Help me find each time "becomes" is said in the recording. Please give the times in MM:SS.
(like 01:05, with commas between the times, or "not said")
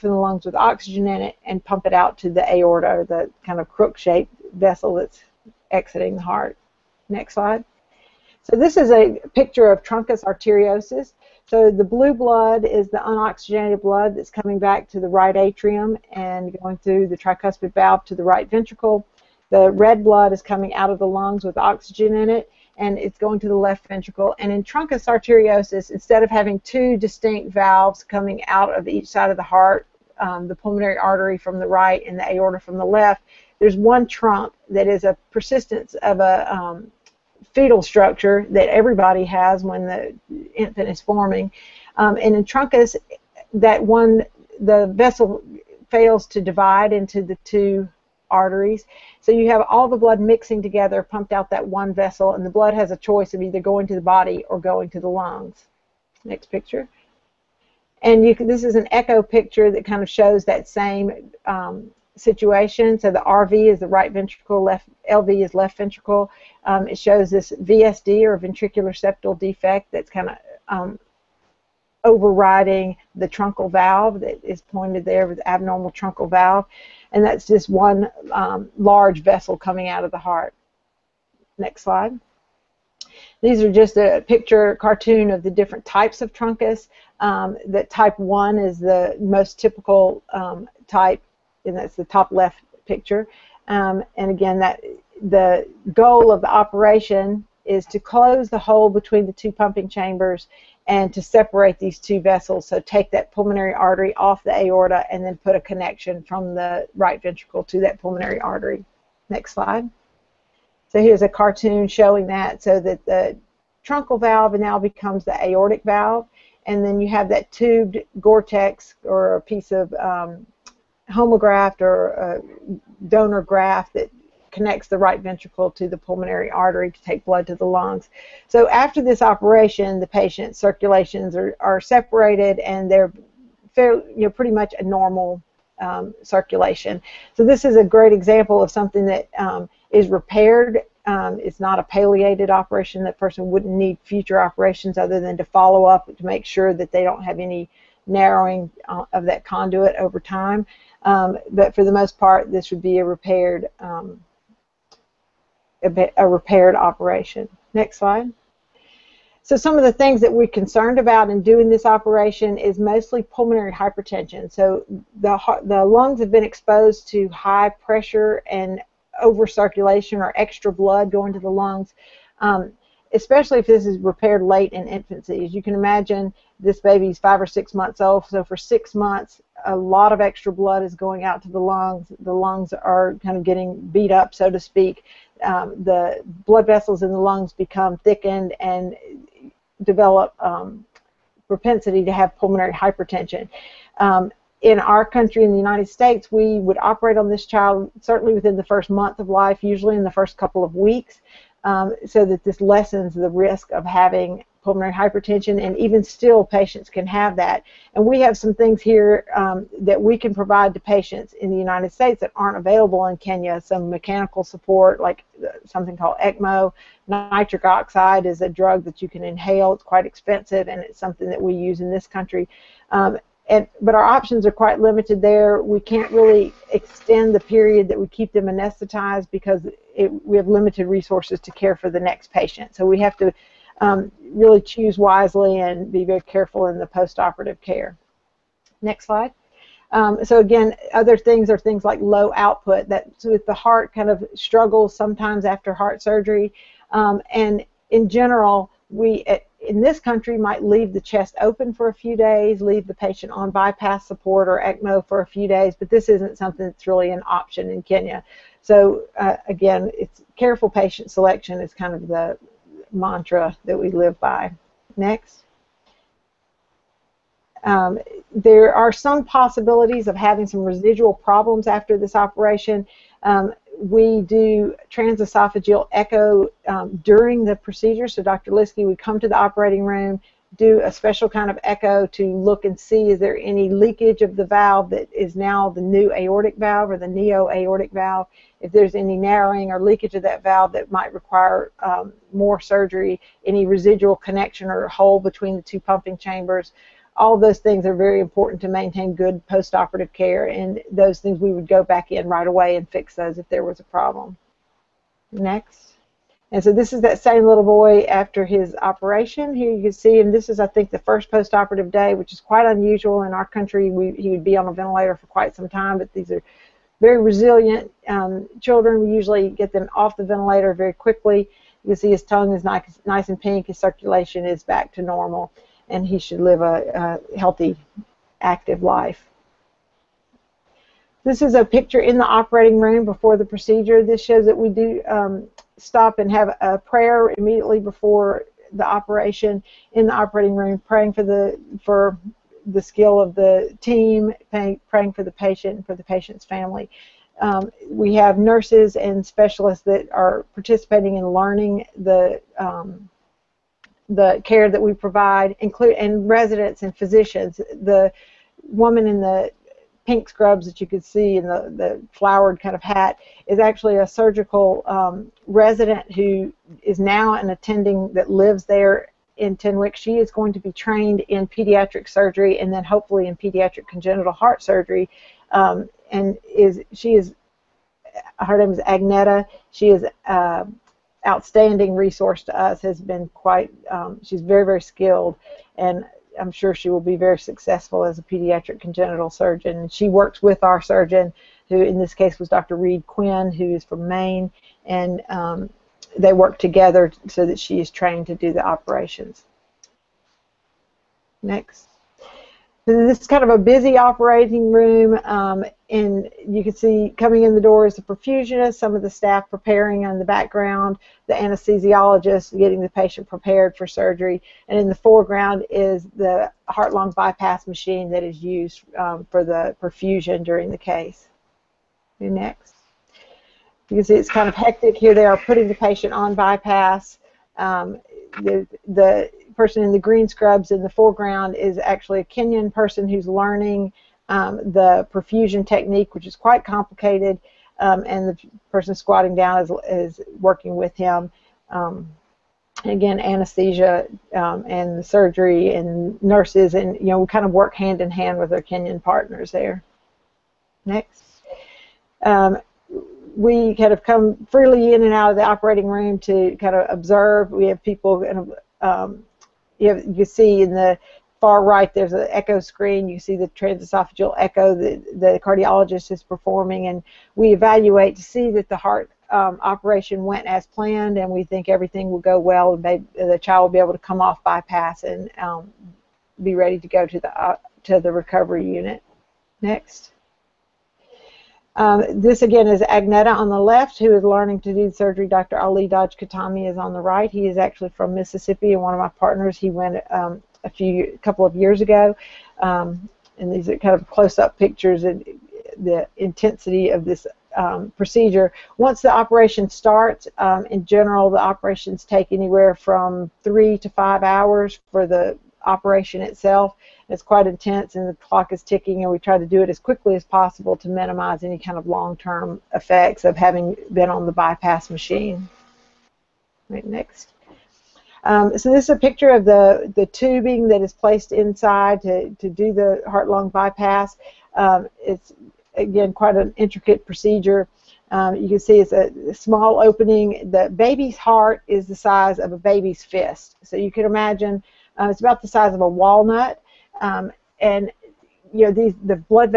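01:54, 03:07.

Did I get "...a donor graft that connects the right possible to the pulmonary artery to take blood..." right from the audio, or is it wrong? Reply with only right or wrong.
wrong.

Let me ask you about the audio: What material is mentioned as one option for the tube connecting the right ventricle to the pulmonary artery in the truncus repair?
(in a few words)
Gore-Tex.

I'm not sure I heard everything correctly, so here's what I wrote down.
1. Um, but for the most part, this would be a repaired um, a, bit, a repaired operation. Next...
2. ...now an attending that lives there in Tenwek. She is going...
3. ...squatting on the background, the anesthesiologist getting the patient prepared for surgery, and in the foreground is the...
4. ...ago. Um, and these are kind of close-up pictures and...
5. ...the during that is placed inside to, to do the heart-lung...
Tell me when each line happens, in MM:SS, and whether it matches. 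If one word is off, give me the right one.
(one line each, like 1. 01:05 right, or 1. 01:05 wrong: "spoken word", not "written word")
1. 02:31 right
2. 06:06 right
3. 06:49 wrong: "preparing", not "squatting"
4. 08:11 right
5. 08:39 wrong: "tubing", not "during".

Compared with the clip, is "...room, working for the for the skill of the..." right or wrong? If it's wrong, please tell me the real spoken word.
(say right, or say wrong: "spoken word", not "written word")
wrong: "praying", not "working".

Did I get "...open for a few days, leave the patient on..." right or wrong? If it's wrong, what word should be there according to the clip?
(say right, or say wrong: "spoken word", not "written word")
right.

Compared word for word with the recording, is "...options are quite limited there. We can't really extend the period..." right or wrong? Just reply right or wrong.
right.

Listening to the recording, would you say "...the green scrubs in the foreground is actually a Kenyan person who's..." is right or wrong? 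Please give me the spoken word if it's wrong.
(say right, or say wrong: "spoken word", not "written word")
right.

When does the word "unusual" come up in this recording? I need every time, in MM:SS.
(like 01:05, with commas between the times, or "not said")
05:12.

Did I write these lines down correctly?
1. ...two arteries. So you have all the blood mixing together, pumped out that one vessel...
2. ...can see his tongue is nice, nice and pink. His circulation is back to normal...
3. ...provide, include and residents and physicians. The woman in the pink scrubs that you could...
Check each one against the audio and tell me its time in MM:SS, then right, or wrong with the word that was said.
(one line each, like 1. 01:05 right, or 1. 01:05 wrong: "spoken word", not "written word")
1. 00:47 right
2. 05:21 right
3. 05:54 right.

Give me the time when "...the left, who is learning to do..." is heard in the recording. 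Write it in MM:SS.
08:03.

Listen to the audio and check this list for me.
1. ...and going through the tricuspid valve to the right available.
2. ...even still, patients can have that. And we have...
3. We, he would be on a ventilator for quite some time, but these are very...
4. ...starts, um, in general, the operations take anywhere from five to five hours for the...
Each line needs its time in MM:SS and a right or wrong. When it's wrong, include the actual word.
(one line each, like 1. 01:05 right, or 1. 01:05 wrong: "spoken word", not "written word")
1. 00:16 wrong: "ventricle", not "available"
2. 03:25 right
3. 05:13 right
4. 08:19 wrong: "three", not "five".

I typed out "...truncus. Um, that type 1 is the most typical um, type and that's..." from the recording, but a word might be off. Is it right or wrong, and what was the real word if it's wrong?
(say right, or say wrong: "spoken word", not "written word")
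right.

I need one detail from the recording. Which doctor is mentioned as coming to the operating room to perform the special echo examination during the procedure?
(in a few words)
Dr. Liskey.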